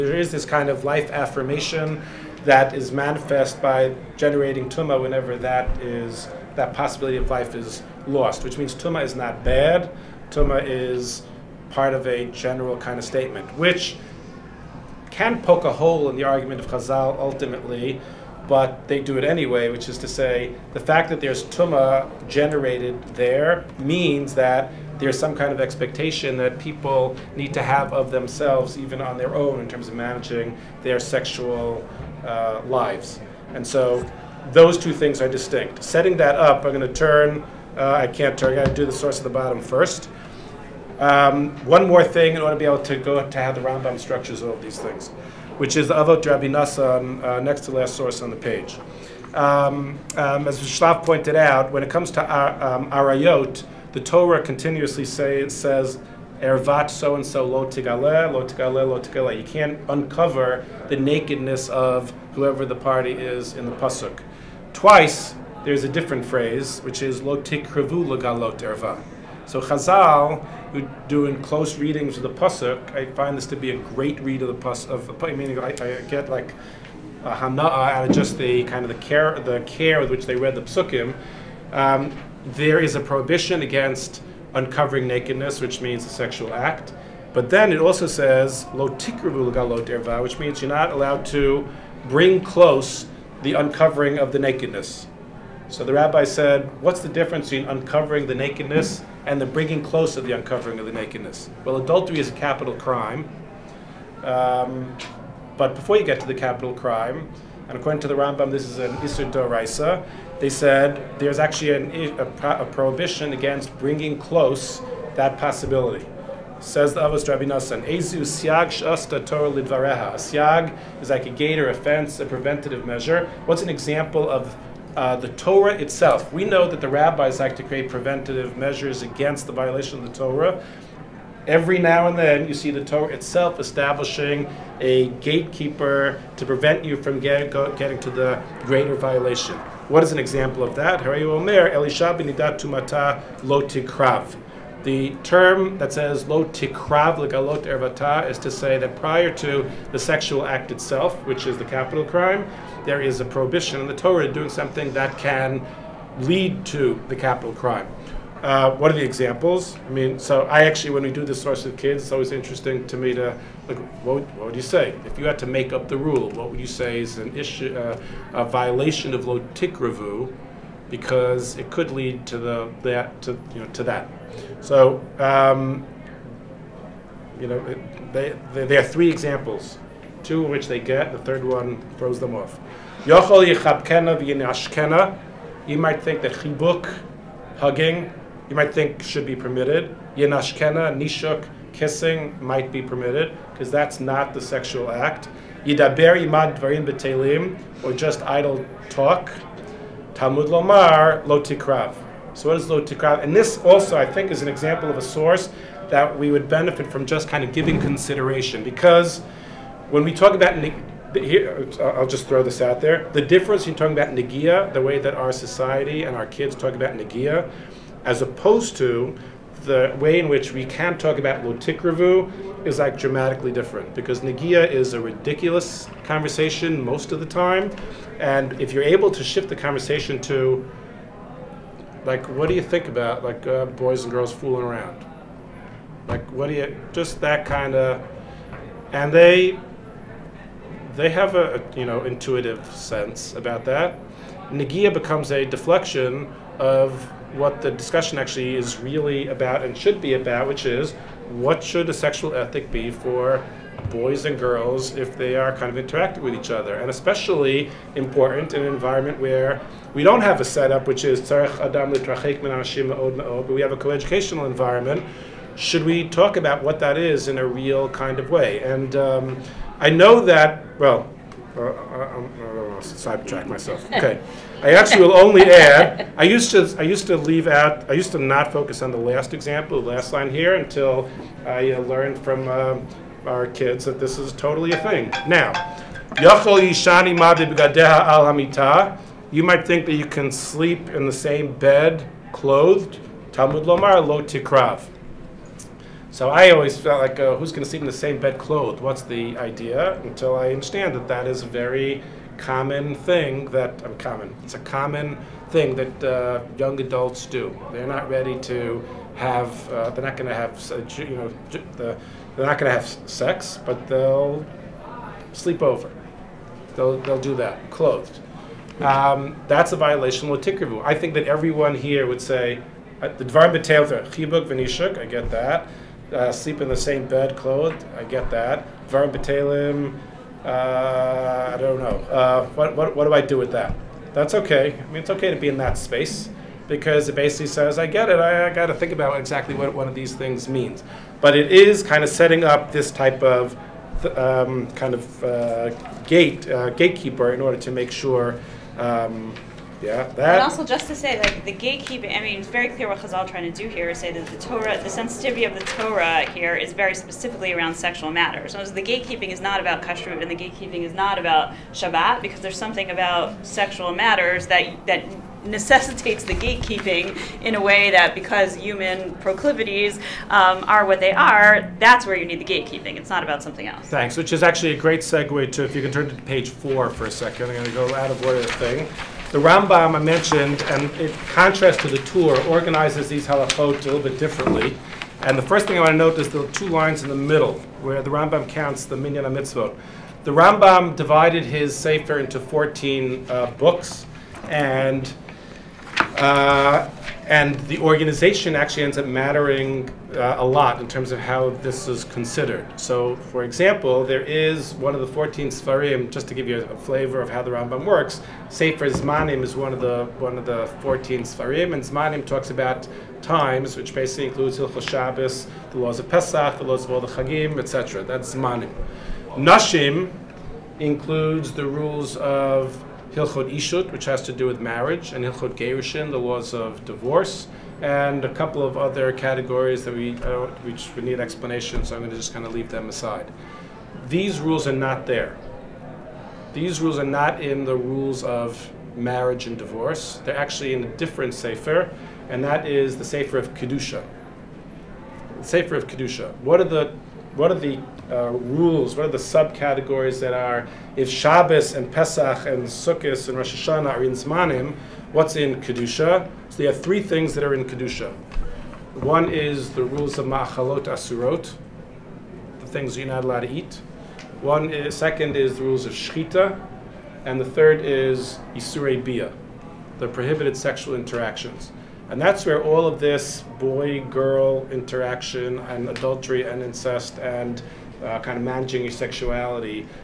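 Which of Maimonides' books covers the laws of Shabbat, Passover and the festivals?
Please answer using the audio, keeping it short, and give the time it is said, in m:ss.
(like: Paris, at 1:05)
Sefer Zmanim, at 6:48.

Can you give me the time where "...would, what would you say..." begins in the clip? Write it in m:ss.
2:44.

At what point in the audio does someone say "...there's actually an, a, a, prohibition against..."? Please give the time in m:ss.
1:51.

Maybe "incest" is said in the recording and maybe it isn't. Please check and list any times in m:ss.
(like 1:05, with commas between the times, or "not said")
7:56.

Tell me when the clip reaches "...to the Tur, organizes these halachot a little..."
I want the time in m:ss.
6:21.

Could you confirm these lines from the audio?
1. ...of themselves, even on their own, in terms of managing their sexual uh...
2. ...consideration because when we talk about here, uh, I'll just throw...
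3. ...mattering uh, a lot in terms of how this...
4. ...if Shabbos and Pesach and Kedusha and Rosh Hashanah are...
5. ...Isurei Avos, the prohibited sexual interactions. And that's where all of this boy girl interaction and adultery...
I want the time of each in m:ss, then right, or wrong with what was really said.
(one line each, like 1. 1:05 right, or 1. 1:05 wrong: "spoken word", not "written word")
1. 0:27 right
2. 3:27 right
3. 6:39 right
4. 7:30 wrong: "Sukkot", not "Kedusha"
5. 7:48 wrong: "Bia", not "Avos".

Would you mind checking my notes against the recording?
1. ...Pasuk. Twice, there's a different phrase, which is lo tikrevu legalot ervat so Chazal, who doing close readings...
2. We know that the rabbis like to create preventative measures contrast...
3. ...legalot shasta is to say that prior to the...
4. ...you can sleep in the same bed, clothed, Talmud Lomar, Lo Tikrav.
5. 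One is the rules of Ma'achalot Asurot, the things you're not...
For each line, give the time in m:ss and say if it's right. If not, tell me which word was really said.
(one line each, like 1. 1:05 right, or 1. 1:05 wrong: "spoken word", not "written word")
1. 1:03 wrong: "lagalot", not "legalot"
2. 2:06 wrong: "against", not "contrast"
3. 2:27 wrong: "ervata", not "shasta"
4. 4:49 right
5. 7:39 right.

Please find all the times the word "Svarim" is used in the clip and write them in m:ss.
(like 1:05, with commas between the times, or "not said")
6:45, 6:51.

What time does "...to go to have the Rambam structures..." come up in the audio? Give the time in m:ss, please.
0:42.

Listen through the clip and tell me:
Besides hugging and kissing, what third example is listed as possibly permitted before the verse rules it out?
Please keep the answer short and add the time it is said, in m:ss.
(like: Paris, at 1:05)
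idle talk, at 3:18.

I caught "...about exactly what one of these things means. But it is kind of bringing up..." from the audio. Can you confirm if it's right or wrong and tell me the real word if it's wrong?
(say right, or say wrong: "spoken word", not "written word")
wrong: "setting", not "bringing".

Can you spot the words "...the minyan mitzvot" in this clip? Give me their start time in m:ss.
6:28.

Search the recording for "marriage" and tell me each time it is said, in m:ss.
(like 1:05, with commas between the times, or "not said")
7:04, 7:18.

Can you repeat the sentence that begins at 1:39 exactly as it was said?
and the bringing close of the uncovering of the nakedness.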